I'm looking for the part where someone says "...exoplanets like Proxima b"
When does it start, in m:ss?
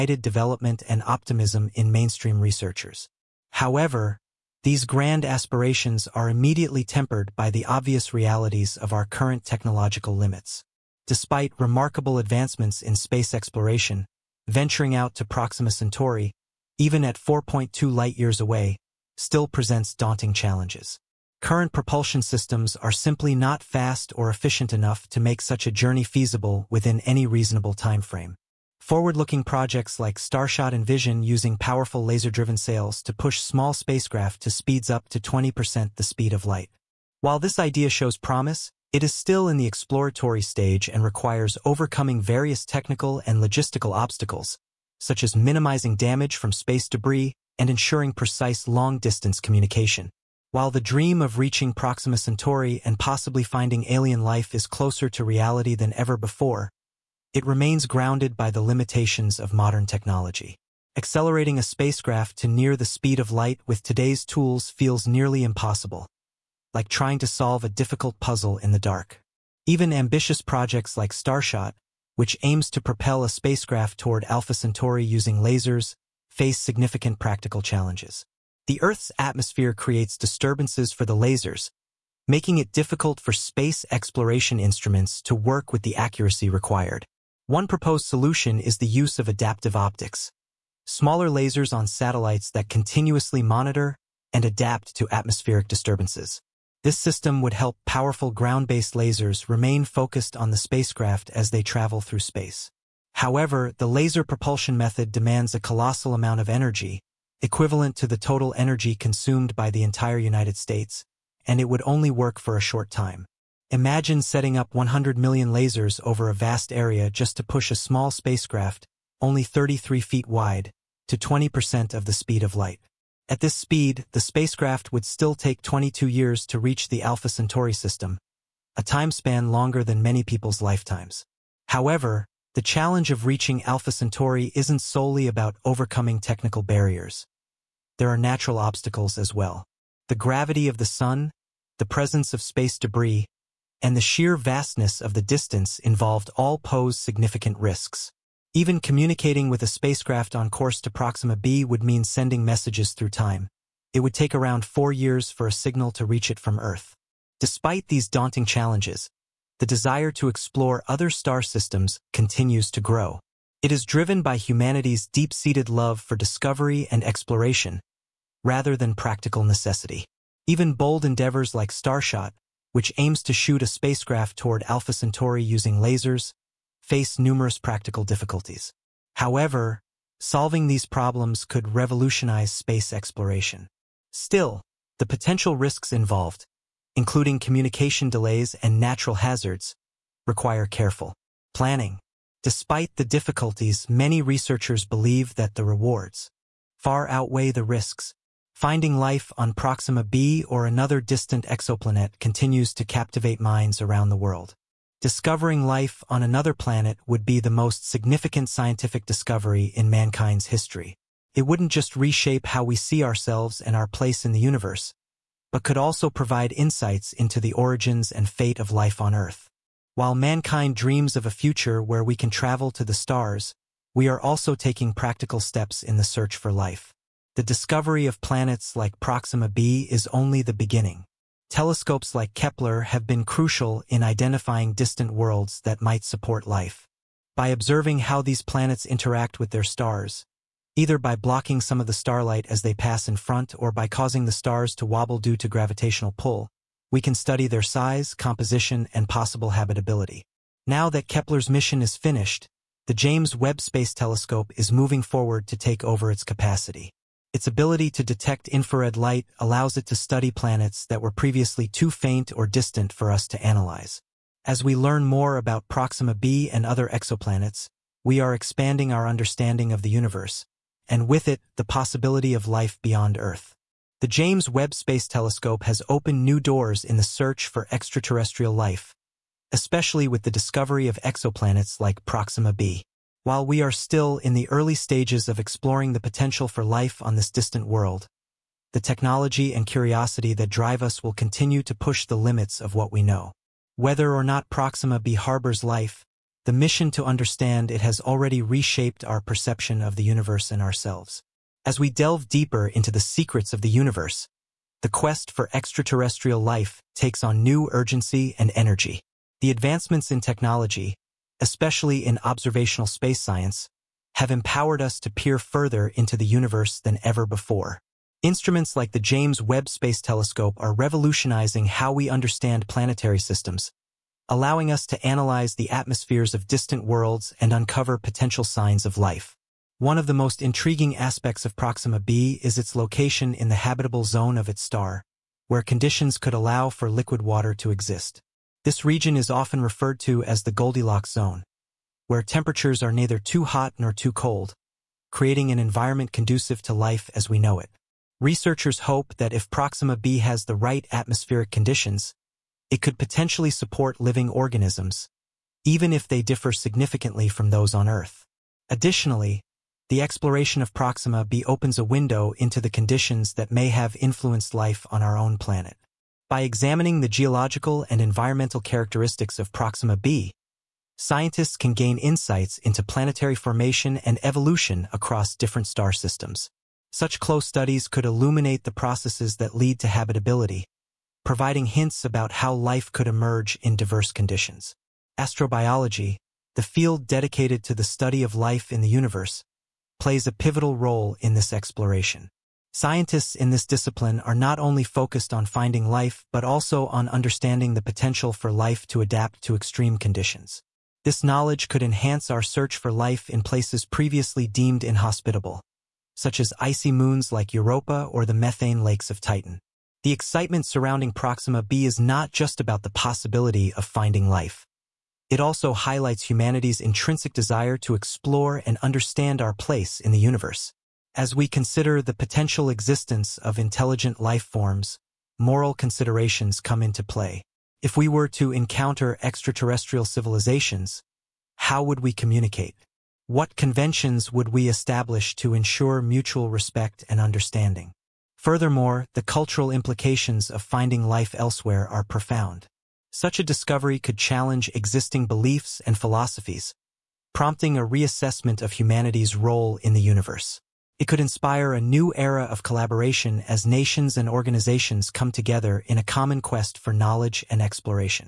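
4:41.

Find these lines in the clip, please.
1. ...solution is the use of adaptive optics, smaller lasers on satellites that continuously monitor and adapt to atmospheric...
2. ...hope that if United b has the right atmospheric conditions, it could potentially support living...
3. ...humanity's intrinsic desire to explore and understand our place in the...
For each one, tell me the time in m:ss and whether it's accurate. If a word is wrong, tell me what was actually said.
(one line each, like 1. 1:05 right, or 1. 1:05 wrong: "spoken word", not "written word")
1. 1:28 right
2. 5:48 wrong: "Proxima", not "United"
3. 6:56 right.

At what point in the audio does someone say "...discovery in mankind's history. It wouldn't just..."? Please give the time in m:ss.
3:29.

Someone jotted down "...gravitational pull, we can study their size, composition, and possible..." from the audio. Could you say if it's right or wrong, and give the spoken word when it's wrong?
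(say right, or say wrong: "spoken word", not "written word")
right.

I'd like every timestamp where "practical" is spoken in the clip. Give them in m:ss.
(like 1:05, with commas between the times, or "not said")
1:17, 2:48, 2:57, 3:44.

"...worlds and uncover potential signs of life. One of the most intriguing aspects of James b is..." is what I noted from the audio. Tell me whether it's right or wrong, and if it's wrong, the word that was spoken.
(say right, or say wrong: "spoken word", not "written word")
wrong: "Proxima", not "James".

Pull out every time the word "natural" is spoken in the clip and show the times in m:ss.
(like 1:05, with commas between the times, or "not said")
2:18, 3:08.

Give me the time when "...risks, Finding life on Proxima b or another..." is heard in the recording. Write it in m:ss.
3:17.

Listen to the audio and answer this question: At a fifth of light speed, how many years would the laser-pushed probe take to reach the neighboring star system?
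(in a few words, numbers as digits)
22 years.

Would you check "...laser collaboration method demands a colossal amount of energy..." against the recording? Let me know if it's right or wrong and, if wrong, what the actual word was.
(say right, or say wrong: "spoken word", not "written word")
wrong: "propulsion", not "collaboration".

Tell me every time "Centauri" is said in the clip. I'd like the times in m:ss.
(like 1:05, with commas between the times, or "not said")
0:15, 0:52, 1:14, 2:07, 2:13, 2:54.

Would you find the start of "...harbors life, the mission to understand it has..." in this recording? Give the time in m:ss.
4:55.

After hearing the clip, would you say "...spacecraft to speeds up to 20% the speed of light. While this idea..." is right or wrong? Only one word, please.
right.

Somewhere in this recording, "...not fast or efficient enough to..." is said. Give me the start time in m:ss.
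0:23.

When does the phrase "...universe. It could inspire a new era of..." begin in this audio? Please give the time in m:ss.
7:30.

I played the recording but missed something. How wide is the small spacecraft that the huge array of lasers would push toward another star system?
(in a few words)
33 feet.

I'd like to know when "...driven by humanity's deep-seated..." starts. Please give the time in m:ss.
2:43.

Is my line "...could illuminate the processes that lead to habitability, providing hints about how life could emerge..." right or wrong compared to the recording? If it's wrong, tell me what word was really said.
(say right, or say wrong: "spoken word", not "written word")
right.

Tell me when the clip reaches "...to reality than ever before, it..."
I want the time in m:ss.
0:55.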